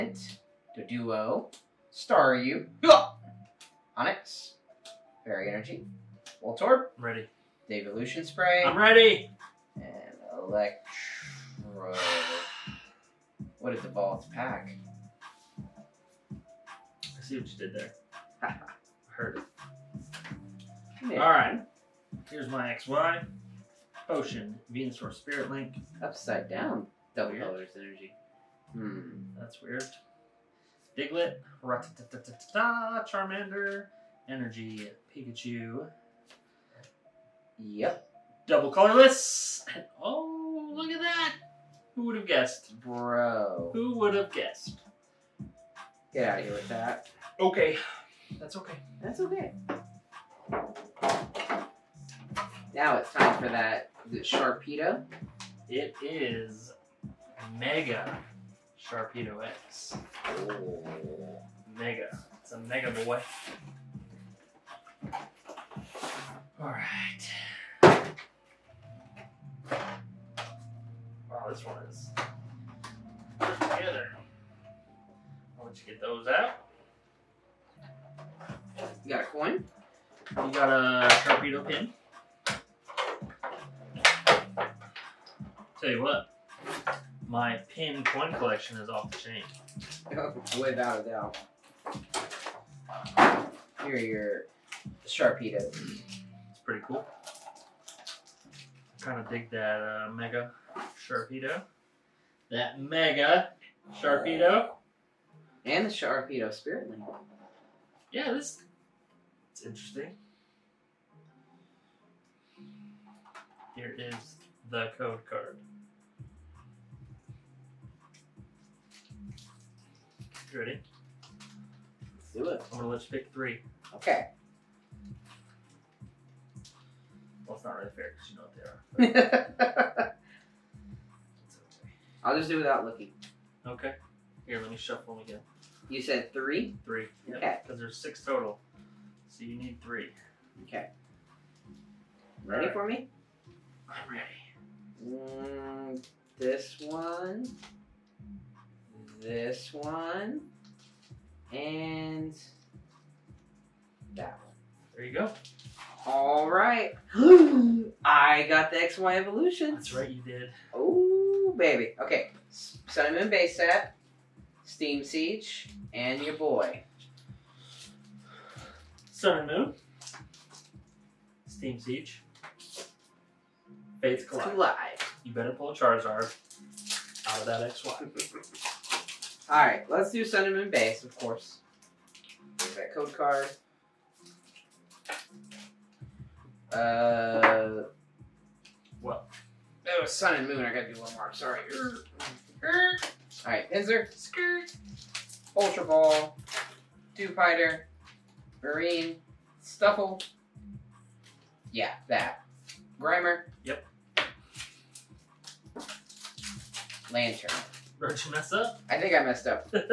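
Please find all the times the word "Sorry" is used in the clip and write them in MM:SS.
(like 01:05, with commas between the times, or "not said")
03:11.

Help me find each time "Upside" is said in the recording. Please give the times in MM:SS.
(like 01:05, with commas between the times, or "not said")
00:26.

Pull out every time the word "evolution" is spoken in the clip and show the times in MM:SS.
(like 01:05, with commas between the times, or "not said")
00:07, 02:39.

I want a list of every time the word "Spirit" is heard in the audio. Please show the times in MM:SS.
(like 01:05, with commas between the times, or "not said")
00:25, 01:46.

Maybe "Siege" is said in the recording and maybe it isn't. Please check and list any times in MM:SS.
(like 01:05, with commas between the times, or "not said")
02:45, 02:51.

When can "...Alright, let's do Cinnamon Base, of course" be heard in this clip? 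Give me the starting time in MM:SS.
02:59.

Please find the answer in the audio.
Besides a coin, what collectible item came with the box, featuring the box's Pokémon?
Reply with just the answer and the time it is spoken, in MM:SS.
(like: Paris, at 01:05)
Sharpedo pin, at 01:21.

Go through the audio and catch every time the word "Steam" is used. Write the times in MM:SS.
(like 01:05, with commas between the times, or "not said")
02:44, 02:51.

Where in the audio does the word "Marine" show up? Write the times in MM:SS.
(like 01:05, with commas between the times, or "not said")
03:18.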